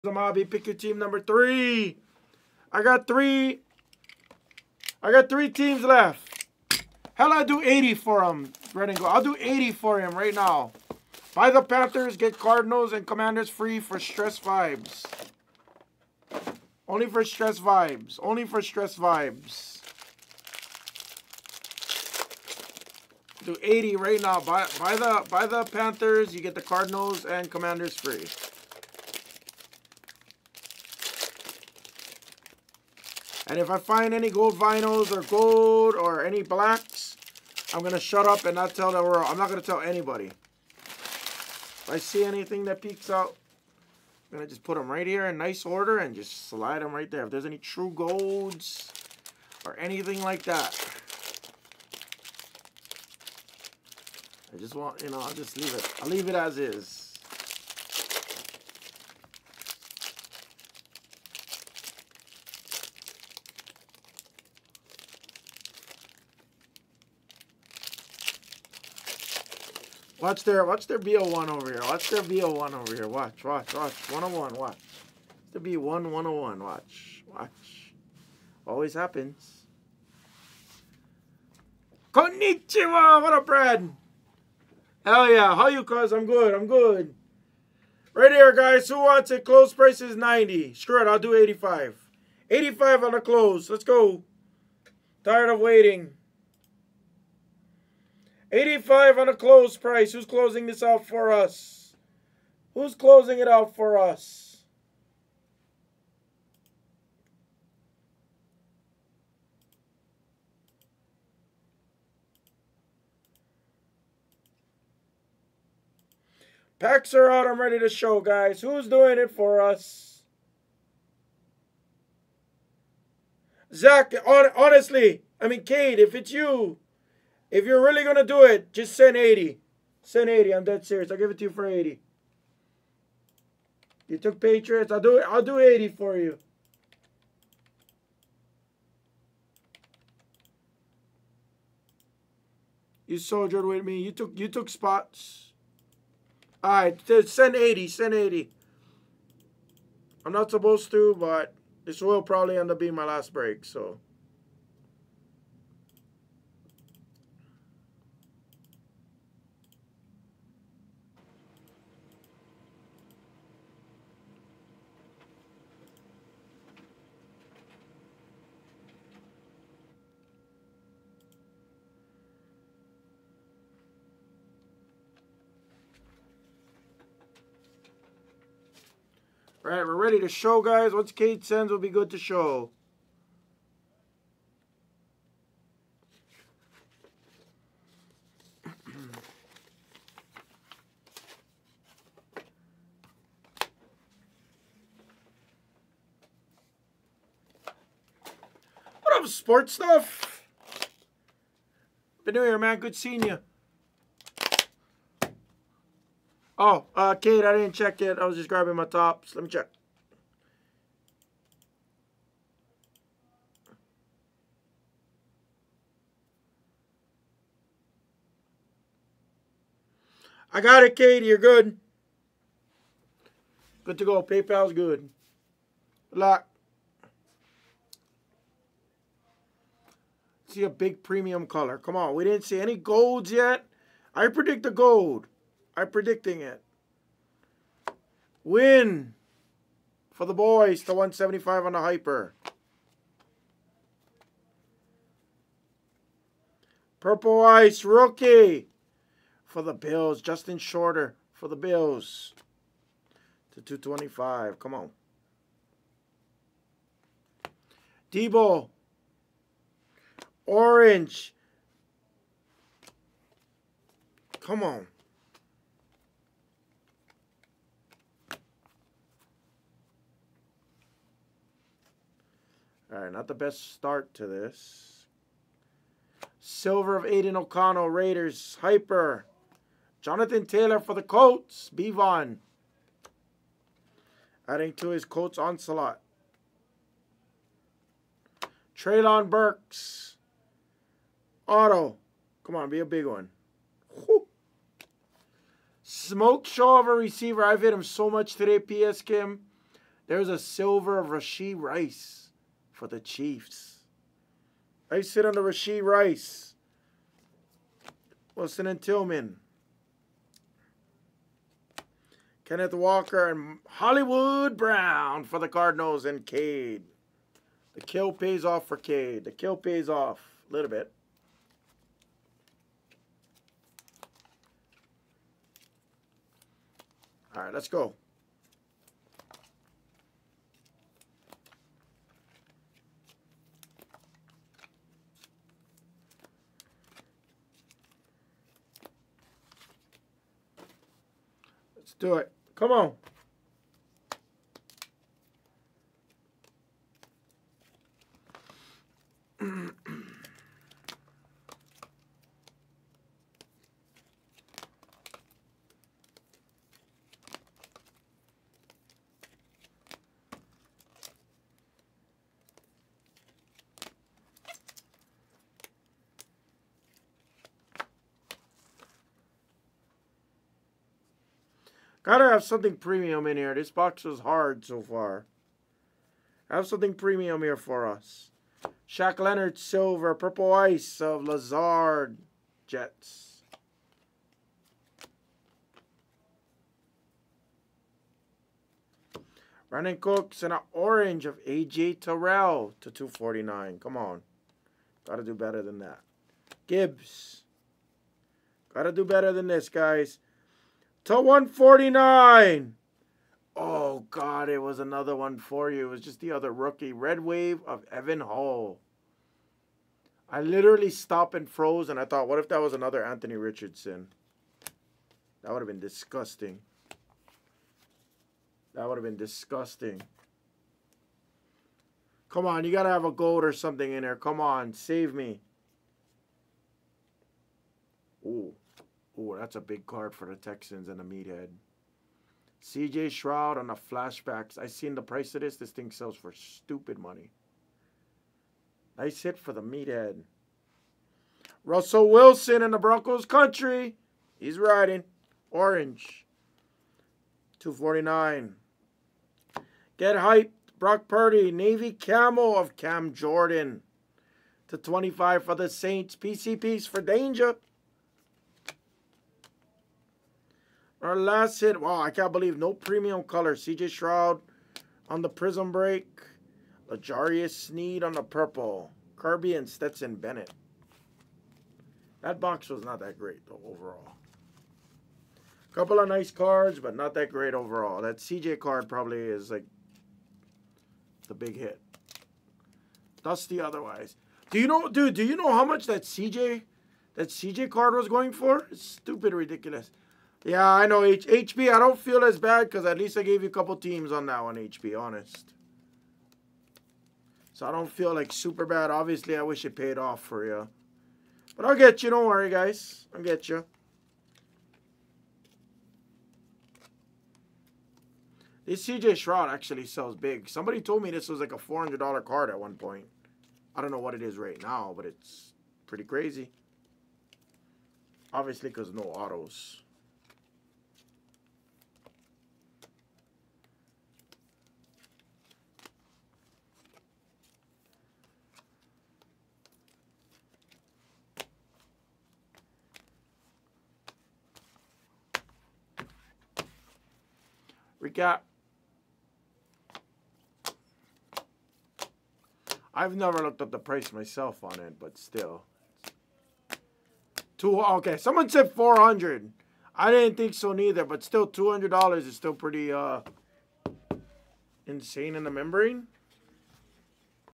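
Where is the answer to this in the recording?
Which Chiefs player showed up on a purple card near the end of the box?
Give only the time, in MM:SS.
07:46.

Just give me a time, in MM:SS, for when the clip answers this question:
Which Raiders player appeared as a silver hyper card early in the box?
04:37.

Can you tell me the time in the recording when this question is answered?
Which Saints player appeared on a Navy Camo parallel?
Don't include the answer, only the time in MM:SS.
07:32.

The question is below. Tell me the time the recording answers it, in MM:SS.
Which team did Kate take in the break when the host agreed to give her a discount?
02:14.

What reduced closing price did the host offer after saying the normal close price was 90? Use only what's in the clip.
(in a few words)
85.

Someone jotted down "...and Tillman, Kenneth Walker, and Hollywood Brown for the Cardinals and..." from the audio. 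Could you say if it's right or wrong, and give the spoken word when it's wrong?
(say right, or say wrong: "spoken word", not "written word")
right.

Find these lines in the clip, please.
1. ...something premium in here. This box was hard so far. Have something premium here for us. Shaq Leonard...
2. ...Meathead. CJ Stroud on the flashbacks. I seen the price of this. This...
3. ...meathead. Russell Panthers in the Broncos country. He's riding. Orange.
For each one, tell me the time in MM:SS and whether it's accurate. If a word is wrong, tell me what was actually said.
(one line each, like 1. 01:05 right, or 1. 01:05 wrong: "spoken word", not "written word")
1. 06:12 right
2. 07:11 right
3. 07:19 wrong: "Wilson", not "Panthers".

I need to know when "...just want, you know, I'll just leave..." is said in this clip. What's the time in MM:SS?
00:54.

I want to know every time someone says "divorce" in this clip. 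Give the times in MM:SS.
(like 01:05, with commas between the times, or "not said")
not said.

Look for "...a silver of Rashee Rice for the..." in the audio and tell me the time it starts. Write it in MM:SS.
05:00.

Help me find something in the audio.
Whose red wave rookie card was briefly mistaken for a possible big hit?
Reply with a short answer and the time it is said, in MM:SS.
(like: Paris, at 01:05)
Evan Hull, at 06:47.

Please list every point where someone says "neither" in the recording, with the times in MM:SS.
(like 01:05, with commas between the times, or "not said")
09:10.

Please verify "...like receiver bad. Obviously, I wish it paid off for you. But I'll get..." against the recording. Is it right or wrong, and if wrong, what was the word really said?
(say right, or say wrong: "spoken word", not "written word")
wrong: "super", not "receiver".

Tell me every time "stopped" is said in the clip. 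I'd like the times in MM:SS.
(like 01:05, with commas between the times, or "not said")
06:50.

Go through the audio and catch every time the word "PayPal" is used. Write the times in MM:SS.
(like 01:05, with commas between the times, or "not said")
03:44.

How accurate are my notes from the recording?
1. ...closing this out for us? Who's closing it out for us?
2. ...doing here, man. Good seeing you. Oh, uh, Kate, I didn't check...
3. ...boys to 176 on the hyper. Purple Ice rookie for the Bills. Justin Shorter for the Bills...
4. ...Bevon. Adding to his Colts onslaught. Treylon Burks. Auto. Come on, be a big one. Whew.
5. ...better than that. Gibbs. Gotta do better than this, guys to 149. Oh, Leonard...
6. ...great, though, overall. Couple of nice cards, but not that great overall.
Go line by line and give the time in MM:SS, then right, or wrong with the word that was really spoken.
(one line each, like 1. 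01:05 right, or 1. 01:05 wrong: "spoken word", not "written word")
1. 01:40 right
2. 03:22 right
3. 04:00 wrong: "175", not "176"
4. 04:41 right
5. 06:35 wrong: "God", not "Leonard"
6. 07:53 right.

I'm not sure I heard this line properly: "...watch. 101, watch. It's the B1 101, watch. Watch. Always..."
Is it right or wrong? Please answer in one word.
right.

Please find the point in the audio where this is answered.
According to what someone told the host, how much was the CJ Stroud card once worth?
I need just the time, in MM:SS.
08:31.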